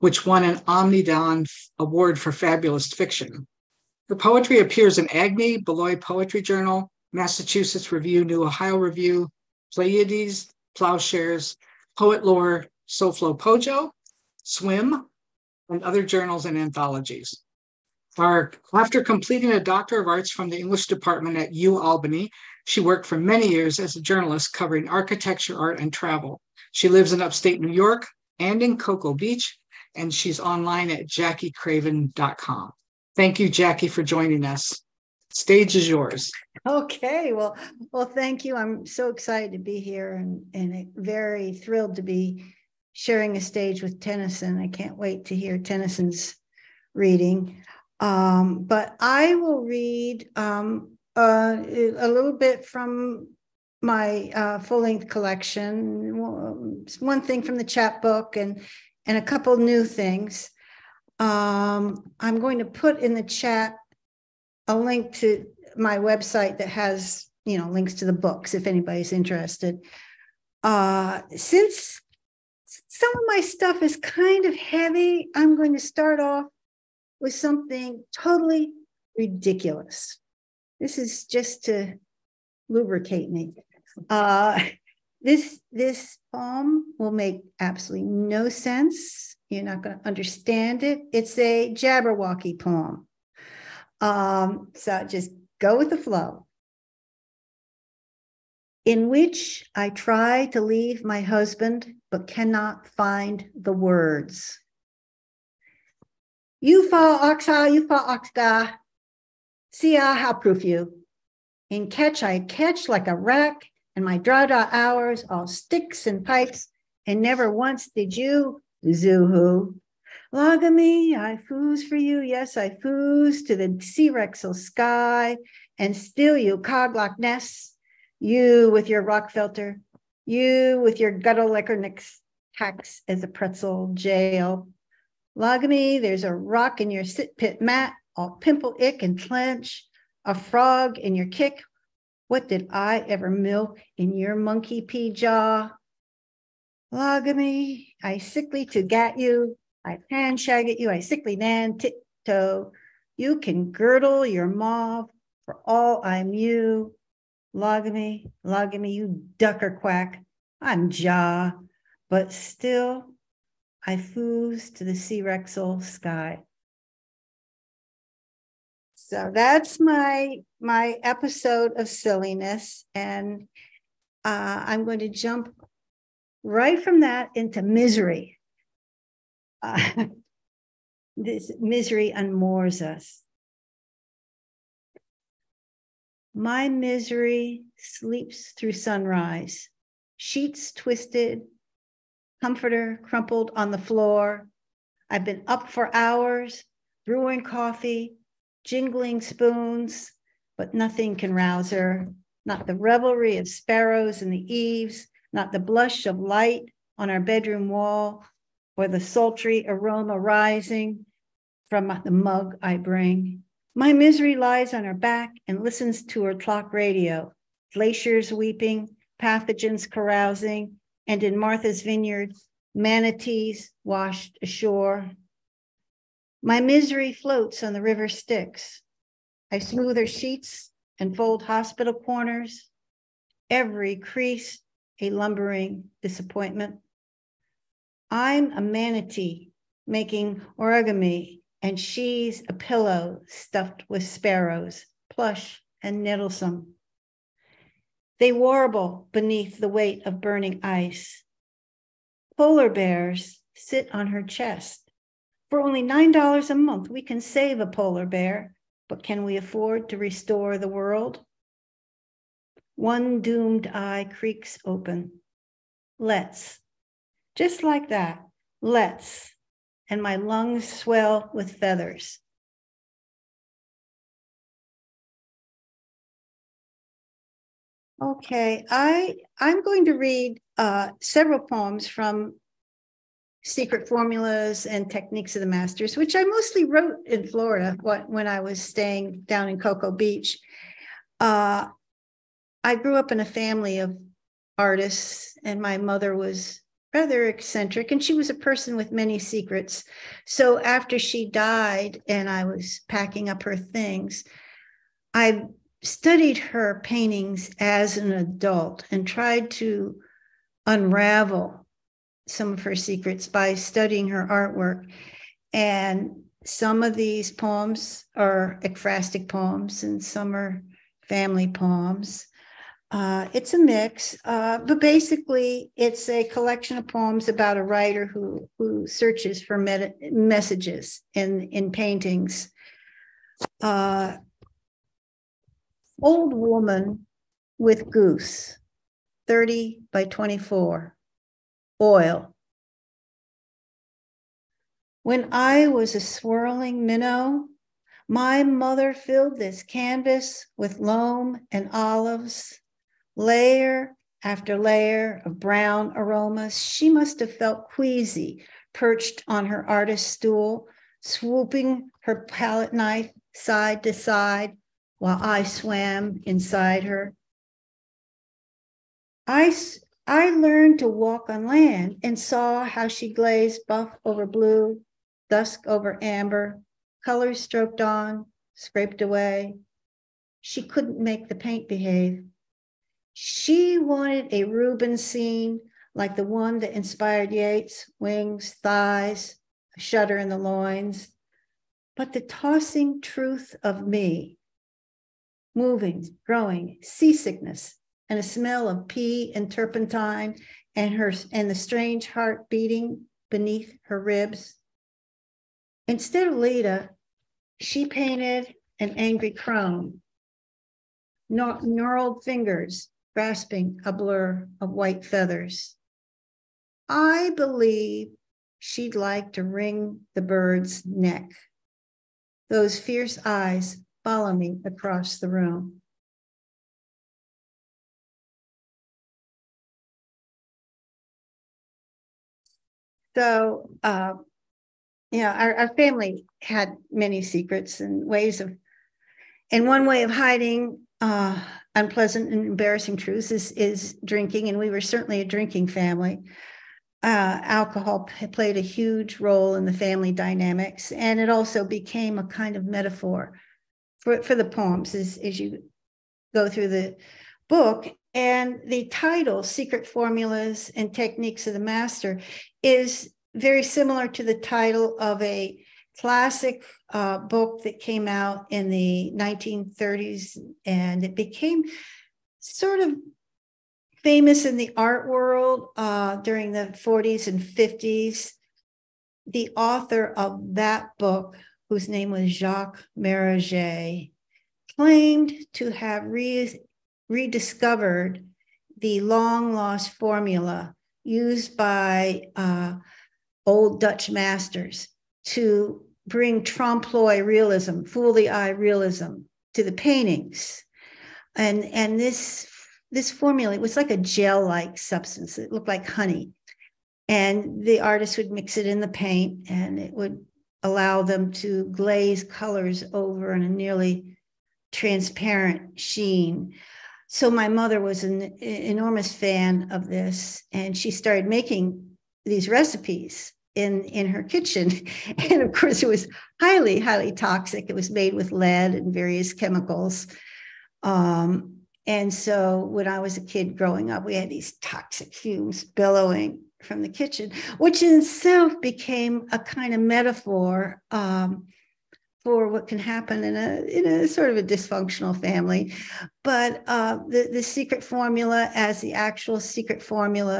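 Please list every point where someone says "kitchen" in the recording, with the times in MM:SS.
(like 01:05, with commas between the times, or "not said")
08:44, 08:56.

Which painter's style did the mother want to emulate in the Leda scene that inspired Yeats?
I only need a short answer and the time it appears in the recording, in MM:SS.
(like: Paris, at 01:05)
Rubens, at 06:24.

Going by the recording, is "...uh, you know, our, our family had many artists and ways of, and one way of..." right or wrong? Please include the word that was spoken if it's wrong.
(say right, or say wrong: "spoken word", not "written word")
wrong: "secrets", not "artists".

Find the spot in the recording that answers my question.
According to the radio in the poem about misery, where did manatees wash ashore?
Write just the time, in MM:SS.
03:41.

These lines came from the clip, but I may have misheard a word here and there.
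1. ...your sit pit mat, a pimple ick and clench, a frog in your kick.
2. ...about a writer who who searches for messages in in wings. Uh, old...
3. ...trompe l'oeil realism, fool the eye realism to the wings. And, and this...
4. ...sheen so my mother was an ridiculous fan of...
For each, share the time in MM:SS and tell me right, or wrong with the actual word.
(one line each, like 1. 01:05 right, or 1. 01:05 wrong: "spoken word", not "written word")
1. 02:16 right
2. 05:27 wrong: "paintings", not "wings"
3. 08:16 wrong: "paintings", not "wings"
4. 08:35 wrong: "enormous", not "ridiculous".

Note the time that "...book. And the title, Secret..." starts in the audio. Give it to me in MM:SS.
07:37.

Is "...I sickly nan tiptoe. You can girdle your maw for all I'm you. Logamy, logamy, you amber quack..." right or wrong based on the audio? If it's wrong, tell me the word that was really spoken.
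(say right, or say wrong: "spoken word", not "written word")
wrong: "ducker", not "amber".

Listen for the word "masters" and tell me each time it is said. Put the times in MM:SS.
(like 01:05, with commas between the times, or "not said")
04:45, 07:41, 08:14.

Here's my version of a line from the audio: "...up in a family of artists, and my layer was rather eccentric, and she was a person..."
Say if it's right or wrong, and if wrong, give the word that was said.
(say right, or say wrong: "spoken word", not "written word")
wrong: "mother", not "layer".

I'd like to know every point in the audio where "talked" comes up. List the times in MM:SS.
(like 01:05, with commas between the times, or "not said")
not said.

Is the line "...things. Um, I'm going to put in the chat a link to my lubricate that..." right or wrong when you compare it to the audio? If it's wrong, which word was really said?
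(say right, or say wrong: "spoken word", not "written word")
wrong: "website", not "lubricate".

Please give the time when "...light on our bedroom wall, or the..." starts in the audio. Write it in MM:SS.
03:26.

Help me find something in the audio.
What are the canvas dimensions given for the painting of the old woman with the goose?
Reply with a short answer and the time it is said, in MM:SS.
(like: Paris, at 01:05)
30 by 24, at 05:39.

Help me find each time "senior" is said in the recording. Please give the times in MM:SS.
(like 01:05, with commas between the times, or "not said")
not said.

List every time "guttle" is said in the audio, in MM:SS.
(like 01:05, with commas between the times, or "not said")
02:11.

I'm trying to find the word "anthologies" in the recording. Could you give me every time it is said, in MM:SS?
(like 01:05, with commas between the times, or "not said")
00:16.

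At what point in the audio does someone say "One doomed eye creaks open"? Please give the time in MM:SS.
04:22.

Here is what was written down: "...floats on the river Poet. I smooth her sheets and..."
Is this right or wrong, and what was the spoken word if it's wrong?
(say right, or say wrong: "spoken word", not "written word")
wrong: "Styx", not "Poet".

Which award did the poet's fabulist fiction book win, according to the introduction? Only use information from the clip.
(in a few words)
Omnidawn Award.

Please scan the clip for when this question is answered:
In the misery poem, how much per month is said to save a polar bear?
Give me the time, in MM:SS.
04:15.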